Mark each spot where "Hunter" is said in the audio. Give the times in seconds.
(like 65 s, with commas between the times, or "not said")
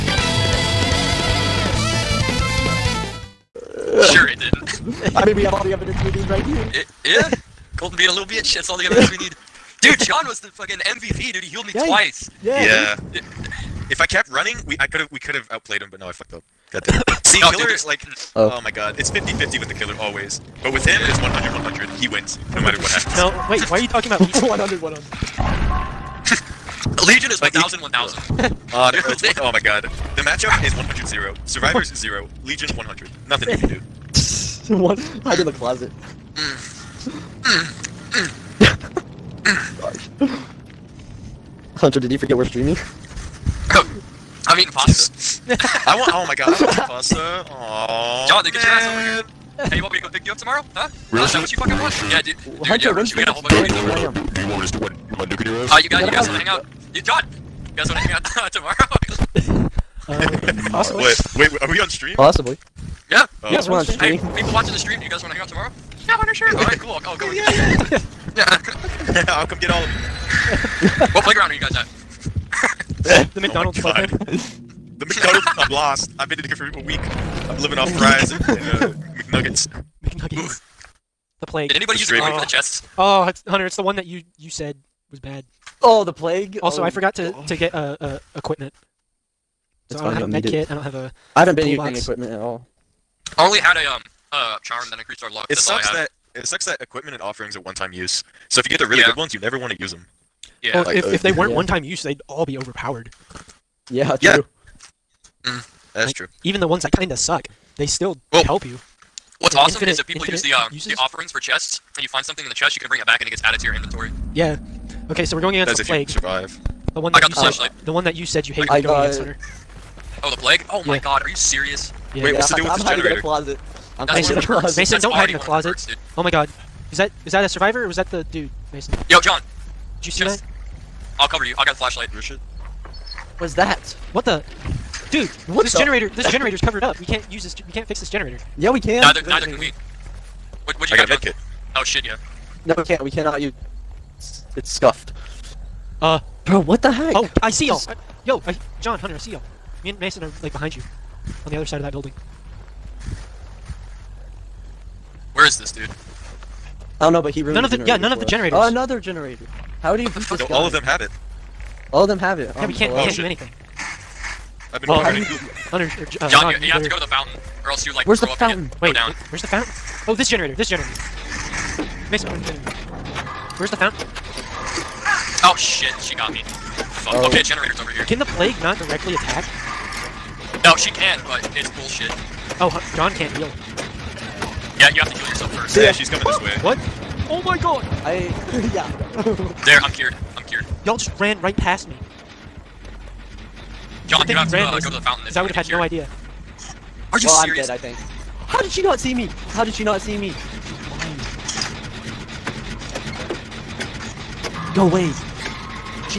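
41 s, 52 s, 83 s, 119 s, 148 s, 165 s.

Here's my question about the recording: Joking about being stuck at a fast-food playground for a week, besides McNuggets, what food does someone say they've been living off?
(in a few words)
fries.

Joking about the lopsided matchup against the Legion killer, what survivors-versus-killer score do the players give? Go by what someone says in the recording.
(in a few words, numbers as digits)
100 0.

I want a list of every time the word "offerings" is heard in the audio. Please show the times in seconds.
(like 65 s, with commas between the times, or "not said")
97 s, 110 s.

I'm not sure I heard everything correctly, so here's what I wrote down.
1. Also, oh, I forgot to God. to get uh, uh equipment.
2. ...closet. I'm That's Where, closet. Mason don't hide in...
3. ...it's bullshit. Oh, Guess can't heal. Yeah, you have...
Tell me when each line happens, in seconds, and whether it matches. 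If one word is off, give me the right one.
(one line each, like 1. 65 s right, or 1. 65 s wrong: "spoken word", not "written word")
1. 86 s right
2. 123 s wrong: "Mason", not "Where"
3. 181 s wrong: "John", not "Guess".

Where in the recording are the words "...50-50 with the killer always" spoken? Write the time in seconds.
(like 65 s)
19 s.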